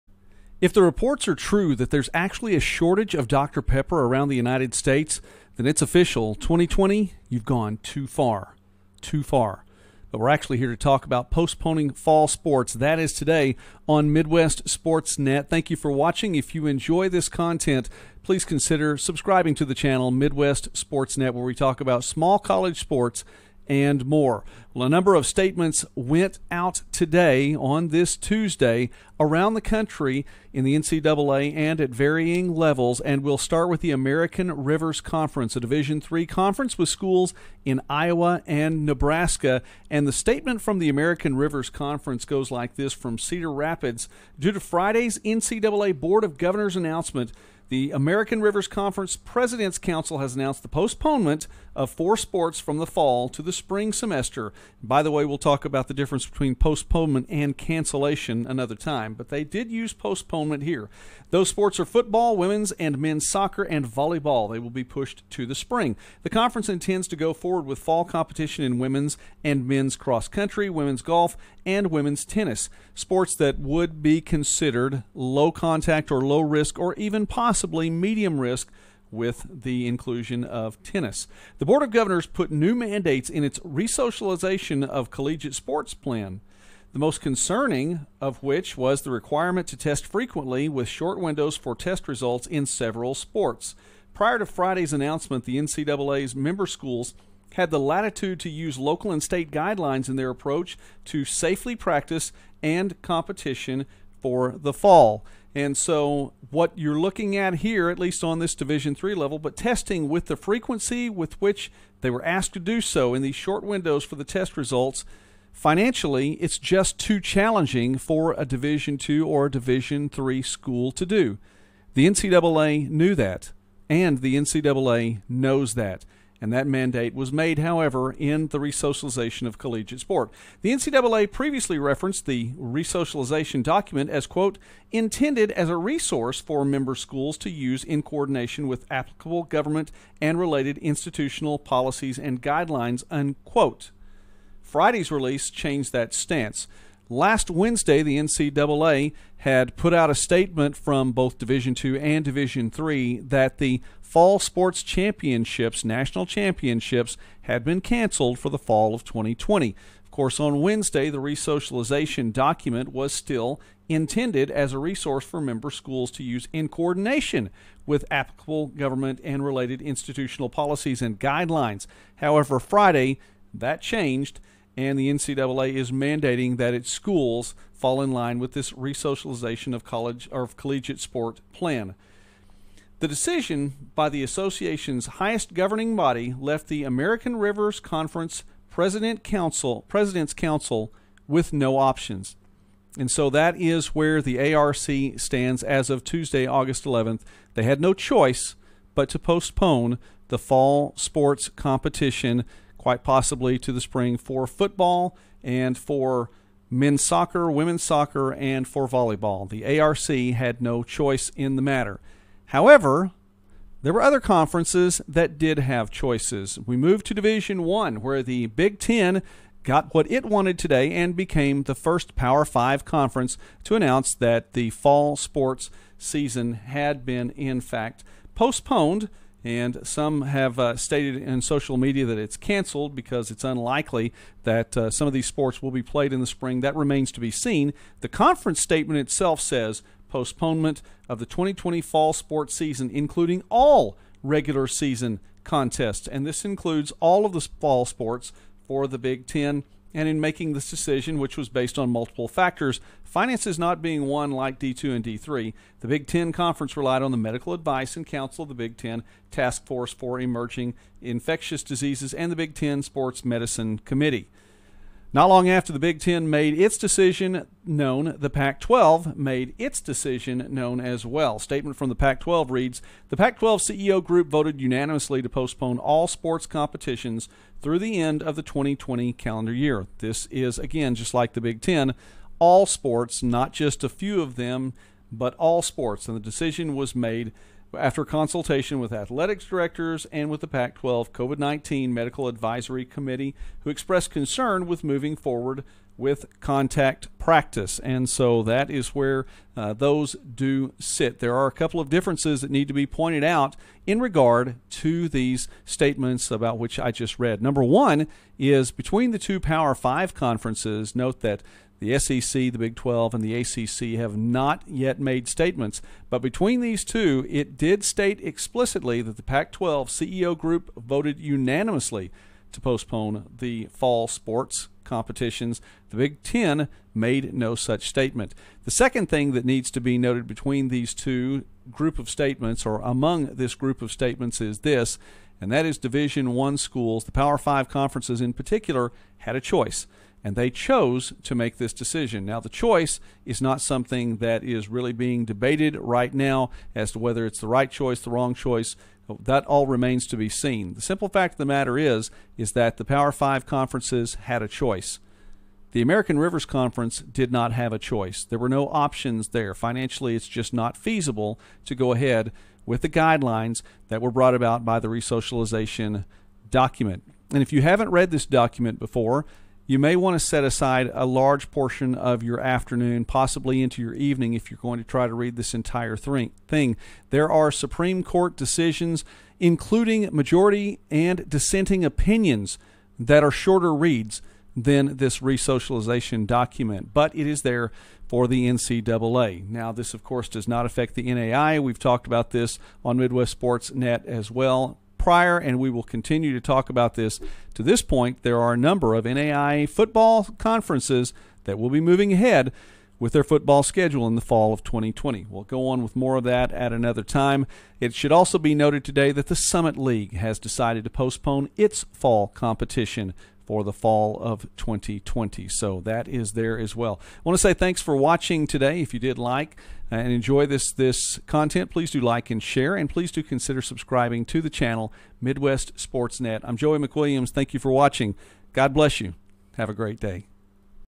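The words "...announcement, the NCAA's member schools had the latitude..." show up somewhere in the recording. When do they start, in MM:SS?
01:34.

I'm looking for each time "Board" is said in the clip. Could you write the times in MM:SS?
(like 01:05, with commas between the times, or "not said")
00:45, 01:21.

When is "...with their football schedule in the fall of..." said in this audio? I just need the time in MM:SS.
06:42.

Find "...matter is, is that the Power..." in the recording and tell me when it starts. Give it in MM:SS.
05:51.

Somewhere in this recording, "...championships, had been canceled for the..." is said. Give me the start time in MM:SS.
02:36.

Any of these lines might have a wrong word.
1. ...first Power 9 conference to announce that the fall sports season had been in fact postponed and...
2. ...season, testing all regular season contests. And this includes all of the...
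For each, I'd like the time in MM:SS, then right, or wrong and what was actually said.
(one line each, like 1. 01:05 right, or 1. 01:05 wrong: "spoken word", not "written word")
1. 03:41 wrong: "5", not "9"
2. 04:02 wrong: "including", not "testing".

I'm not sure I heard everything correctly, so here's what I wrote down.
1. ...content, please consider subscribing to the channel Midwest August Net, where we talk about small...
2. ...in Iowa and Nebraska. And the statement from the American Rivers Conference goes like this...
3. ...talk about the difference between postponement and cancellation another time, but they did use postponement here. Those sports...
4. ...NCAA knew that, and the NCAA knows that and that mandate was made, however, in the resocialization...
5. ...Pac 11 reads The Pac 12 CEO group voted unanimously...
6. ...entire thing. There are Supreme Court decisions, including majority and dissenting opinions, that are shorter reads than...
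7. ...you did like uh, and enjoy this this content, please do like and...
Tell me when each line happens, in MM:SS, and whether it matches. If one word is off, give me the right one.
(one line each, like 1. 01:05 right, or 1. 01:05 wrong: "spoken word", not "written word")
1. 00:17 wrong: "Sports", not "August"
2. 00:37 right
3. 00:55 right
4. 02:02 right
5. 04:31 wrong: "12", not "11"
6. 06:15 right
7. 06:58 right.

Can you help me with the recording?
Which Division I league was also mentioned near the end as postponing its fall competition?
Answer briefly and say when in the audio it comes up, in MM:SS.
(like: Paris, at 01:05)
Summit League, at 06:49.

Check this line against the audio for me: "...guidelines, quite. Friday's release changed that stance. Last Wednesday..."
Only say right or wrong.
wrong.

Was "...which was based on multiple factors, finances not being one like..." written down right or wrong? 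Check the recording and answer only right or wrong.
right.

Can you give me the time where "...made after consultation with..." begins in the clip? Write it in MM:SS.
04:46.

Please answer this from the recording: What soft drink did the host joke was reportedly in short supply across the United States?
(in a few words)
Dr. Pepper.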